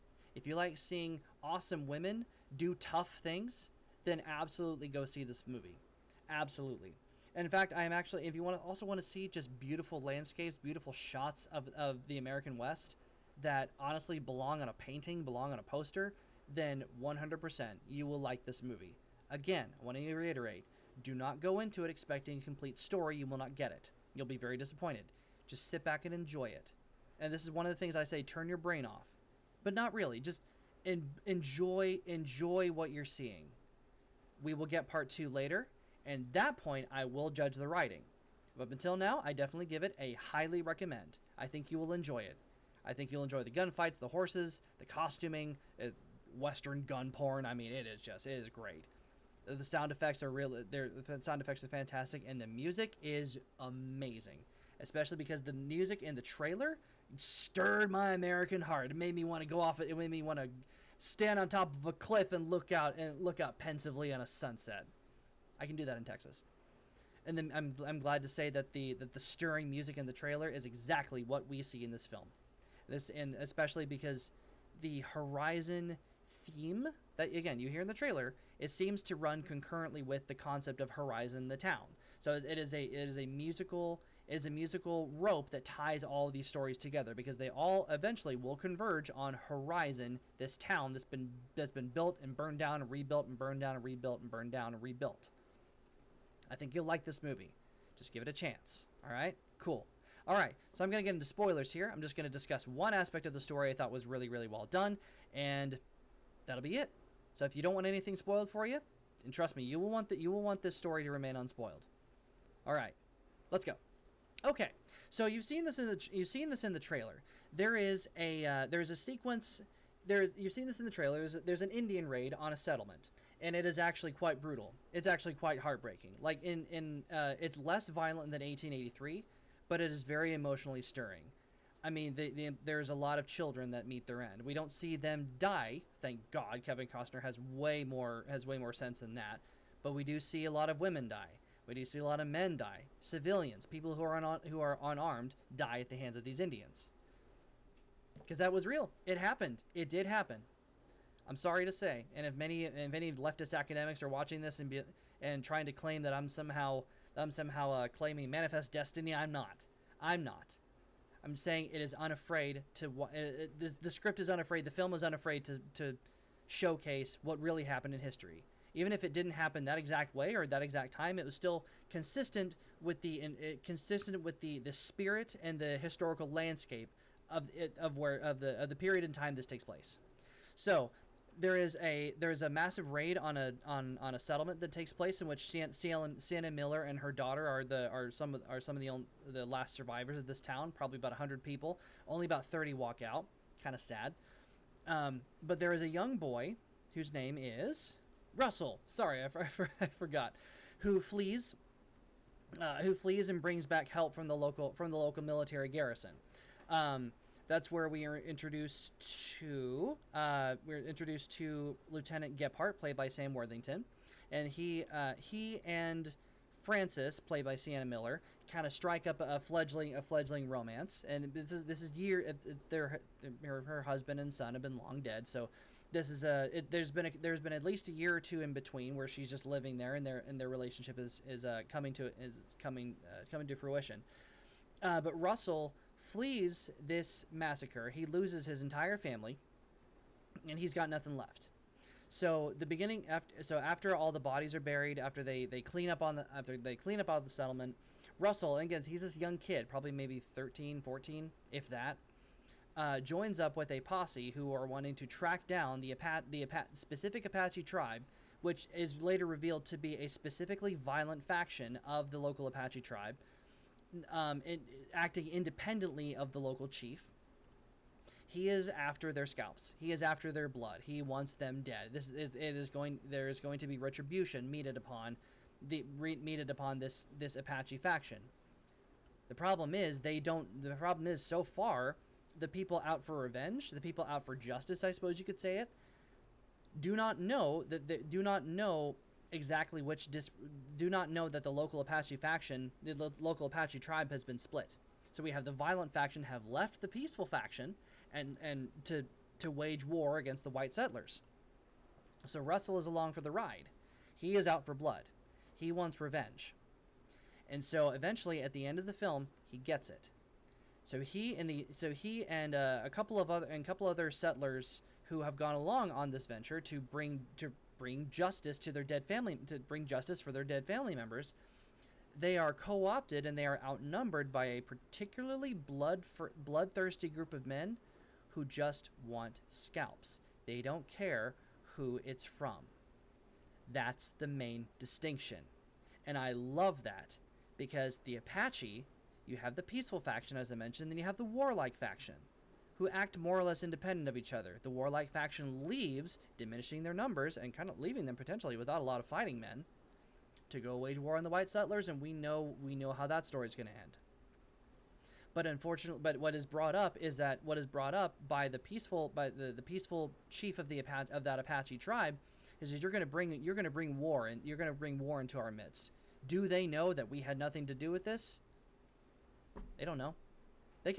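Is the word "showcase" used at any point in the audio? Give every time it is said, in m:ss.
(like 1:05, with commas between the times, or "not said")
2:46.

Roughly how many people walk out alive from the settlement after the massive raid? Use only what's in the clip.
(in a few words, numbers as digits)
30.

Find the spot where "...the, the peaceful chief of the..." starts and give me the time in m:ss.
5:59.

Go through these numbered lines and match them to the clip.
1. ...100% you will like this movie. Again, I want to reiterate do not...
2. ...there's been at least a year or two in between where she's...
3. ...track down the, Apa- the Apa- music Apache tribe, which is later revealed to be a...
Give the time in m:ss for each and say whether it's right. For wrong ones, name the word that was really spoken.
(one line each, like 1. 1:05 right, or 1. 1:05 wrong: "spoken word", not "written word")
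1. 0:17 right
2. 3:47 right
3. 4:15 wrong: "specific", not "music".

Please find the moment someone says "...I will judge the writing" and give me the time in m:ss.
0:36.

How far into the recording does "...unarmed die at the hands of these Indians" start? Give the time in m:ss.
2:24.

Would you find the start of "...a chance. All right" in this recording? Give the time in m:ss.
1:38.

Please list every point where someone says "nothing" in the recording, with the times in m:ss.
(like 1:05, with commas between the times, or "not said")
4:00, 6:07.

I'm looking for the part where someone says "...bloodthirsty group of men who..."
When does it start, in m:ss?
5:26.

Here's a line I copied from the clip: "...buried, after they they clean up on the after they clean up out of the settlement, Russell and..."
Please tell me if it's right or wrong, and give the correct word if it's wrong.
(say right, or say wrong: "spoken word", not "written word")
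right.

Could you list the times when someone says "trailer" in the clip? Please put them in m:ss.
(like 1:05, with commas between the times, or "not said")
0:56, 1:10, 1:17, 1:56, 2:00.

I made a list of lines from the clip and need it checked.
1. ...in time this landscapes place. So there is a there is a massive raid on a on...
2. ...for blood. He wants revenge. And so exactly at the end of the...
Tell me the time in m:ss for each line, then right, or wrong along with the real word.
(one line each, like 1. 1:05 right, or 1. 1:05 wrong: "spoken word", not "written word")
1. 2:59 wrong: "takes", not "landscapes"
2. 5:04 wrong: "eventually", not "exactly".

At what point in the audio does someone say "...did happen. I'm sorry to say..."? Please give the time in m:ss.
2:29.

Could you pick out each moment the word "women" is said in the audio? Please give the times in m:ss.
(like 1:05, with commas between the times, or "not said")
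0:01, 2:20.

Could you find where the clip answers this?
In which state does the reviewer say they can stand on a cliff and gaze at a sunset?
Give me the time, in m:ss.
1:06.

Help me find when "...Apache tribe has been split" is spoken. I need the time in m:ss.
4:53.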